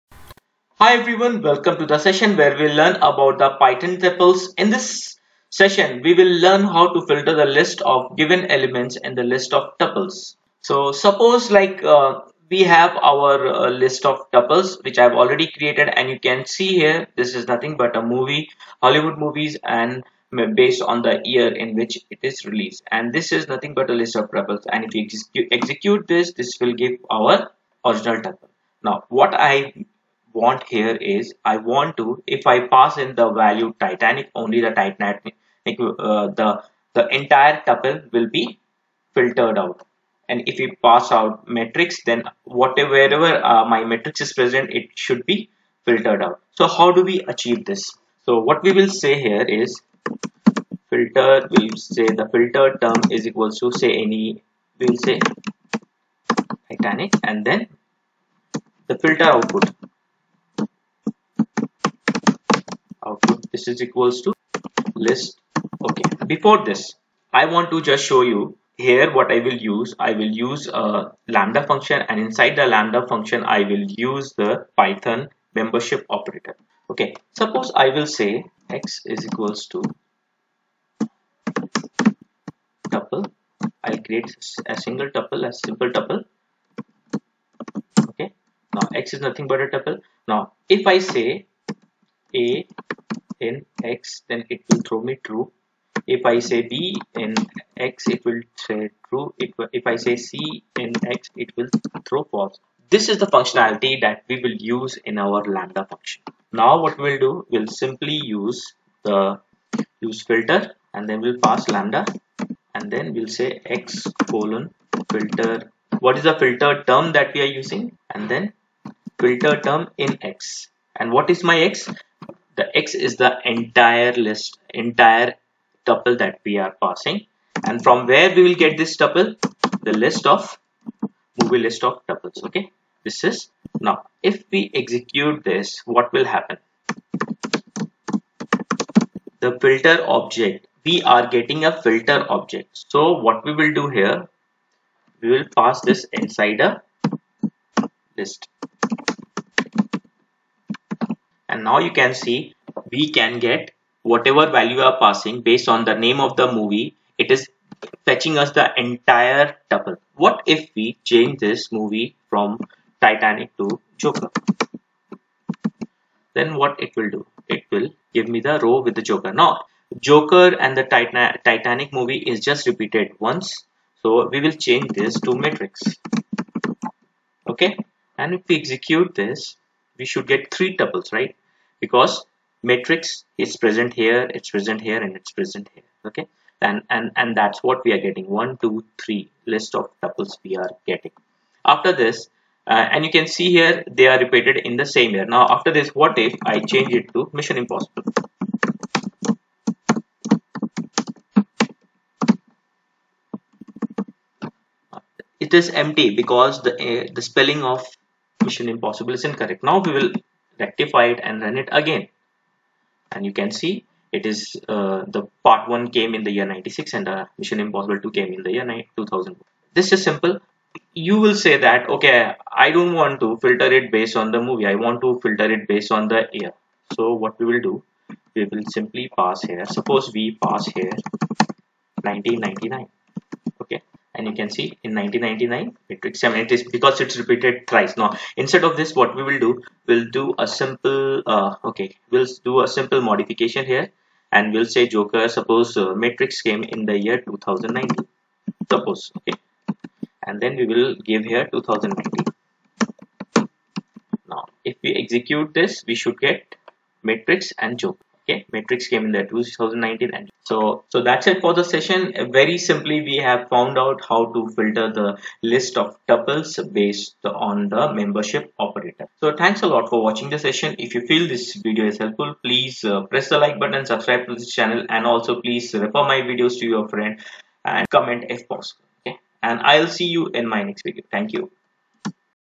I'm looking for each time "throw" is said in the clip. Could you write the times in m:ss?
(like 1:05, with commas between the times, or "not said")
1:34, 1:42.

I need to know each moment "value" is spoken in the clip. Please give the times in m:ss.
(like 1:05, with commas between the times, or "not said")
0:33, 2:34.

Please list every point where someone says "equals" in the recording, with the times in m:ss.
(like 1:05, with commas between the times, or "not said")
0:53, 1:03, 1:19.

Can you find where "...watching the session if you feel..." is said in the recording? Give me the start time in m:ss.
4:30.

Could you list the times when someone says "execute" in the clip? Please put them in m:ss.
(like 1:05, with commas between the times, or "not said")
0:25, 2:14, 2:58, 4:15.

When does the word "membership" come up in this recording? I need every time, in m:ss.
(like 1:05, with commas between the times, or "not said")
1:15, 4:27.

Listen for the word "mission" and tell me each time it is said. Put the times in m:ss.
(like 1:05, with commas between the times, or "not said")
3:17, 3:28, 3:37.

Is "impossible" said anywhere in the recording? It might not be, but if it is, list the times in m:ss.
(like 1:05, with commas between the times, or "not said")
3:17, 3:28, 3:37.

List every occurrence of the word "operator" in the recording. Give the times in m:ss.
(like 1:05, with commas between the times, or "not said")
1:16, 4:28.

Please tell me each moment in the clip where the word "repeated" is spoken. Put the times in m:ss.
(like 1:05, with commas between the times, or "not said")
2:52, 3:14, 3:57.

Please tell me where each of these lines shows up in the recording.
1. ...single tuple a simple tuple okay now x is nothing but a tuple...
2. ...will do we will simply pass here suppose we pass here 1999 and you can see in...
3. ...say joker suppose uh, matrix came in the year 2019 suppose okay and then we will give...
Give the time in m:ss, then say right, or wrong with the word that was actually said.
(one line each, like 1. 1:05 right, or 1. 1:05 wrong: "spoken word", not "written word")
1. 1:24 right
2. 3:47 right
3. 4:04 right.